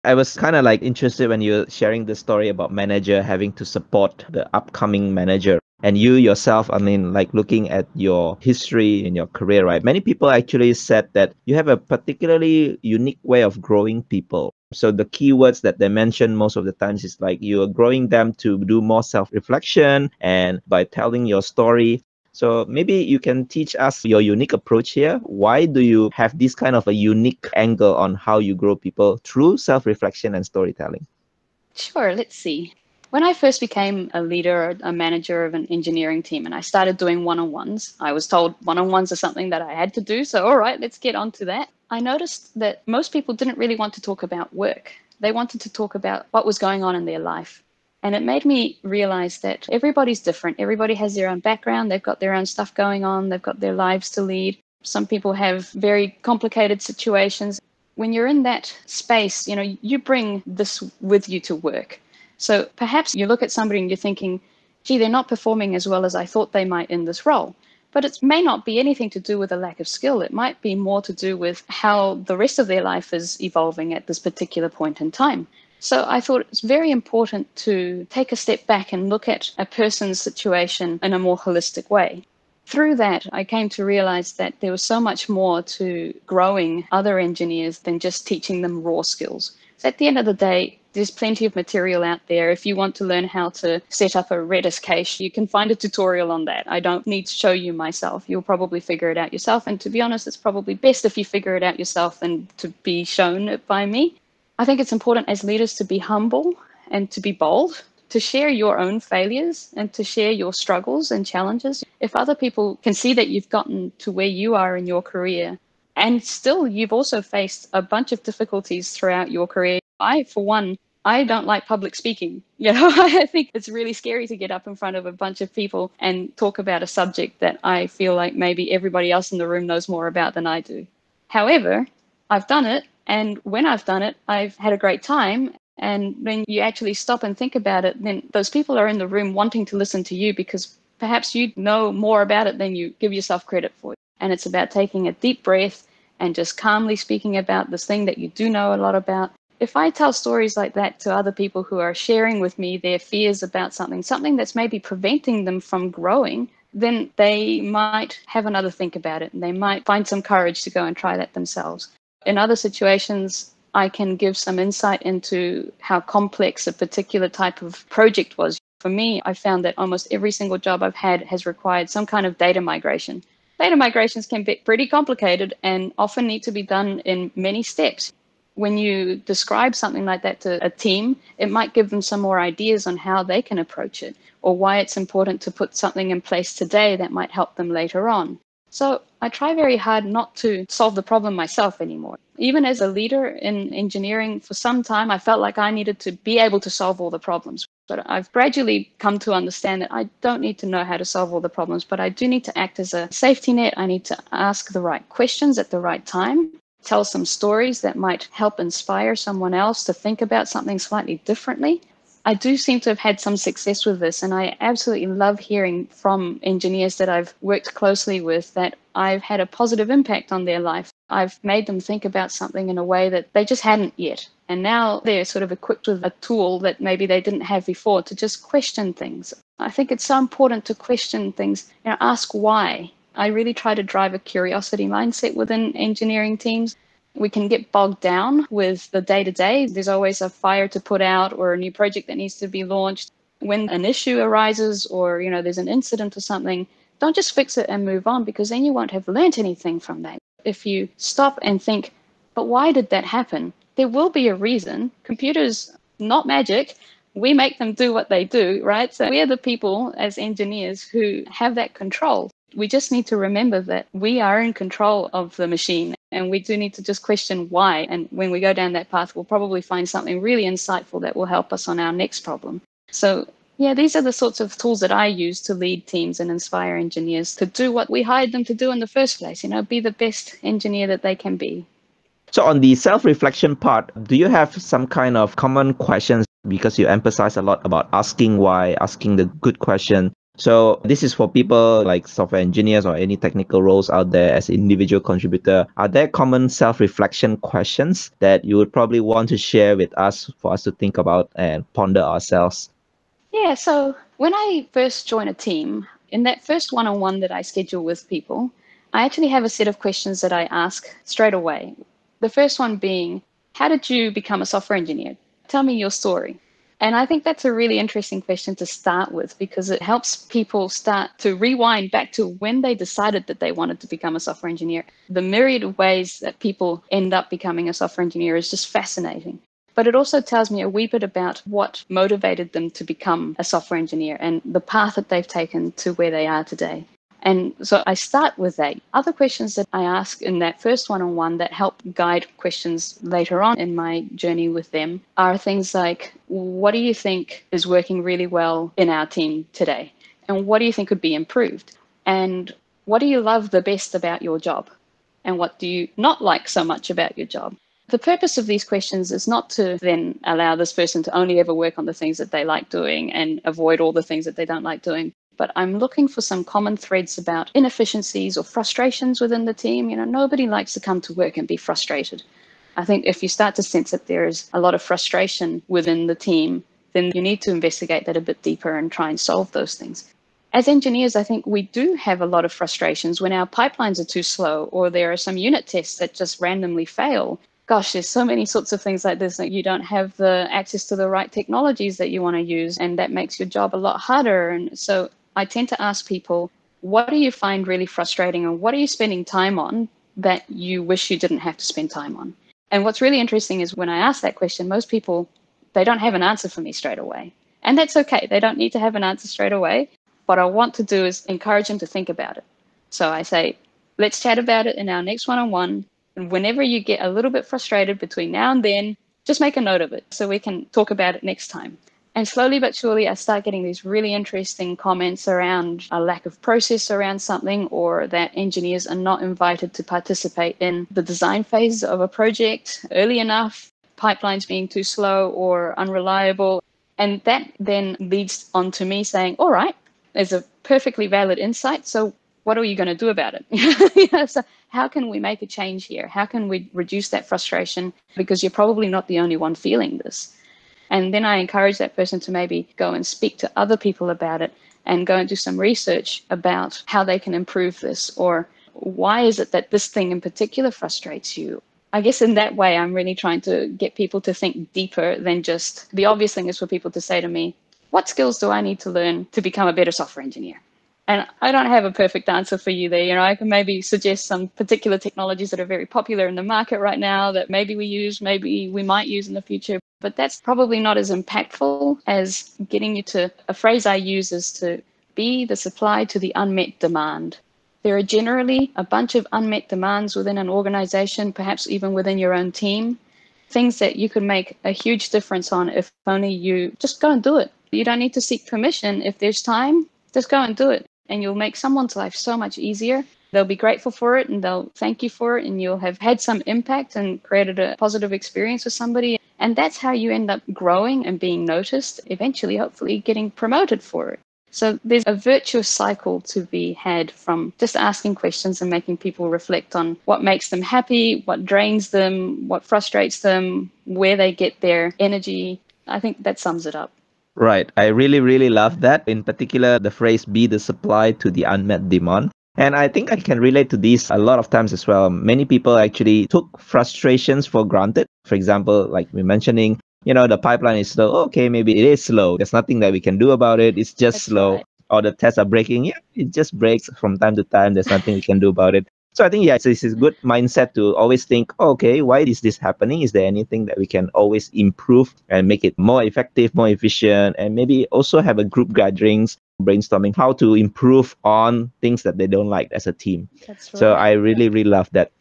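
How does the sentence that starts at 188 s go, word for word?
So I try very hard not to solve the problem myself anymore.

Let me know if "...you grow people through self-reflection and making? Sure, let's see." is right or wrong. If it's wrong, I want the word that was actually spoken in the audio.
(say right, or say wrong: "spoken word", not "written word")
wrong: "storytelling", not "making".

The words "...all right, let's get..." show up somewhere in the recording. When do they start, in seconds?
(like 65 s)
40 s.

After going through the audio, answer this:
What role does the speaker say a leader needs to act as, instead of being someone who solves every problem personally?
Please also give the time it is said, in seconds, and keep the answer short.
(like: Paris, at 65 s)
A safety net, at 203 s.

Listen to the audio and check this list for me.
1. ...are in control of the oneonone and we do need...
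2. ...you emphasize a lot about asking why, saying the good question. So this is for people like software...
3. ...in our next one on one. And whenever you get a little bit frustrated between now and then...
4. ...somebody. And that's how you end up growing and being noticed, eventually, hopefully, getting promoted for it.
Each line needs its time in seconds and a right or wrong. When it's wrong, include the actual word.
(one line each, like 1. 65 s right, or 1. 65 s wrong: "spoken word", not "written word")
1. 264 s wrong: "machine", not "oneonone"
2. 286 s wrong: "asking", not "saying"
3. 414 s right
4. 508 s right.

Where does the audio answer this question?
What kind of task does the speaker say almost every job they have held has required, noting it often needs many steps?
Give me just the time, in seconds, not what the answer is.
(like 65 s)
172 s.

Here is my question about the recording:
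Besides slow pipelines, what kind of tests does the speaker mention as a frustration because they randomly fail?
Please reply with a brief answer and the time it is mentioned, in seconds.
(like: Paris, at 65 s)
Unit tests, at 385 s.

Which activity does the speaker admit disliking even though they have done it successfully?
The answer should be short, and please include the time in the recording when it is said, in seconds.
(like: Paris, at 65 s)
Public speaking, at 121 s.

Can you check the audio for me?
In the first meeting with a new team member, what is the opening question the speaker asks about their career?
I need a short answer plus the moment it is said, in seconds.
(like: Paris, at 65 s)
How did you become a software engineer?, at 313 s.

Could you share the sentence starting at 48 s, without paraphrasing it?
And it made me realize that everybody's different.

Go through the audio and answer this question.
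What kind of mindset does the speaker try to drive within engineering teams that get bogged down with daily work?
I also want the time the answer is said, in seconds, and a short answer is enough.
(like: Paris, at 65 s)
Curiosity mindset, at 234 s.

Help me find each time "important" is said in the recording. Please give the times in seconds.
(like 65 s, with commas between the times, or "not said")
76 s, 104 s, 184 s, 230 s.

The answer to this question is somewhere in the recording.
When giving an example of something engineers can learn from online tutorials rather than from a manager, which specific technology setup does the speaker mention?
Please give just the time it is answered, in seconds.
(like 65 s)
94 s.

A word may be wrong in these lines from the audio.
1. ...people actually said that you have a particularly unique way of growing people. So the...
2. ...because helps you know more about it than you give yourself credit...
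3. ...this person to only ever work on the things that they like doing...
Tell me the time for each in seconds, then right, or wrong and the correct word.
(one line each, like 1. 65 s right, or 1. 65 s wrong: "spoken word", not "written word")
1. 9 s right
2. 140 s wrong: "perhaps", not "helps"
3. 360 s right.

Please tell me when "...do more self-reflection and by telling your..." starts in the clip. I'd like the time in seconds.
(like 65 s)
18 s.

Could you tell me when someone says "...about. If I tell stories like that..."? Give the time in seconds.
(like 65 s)
148 s.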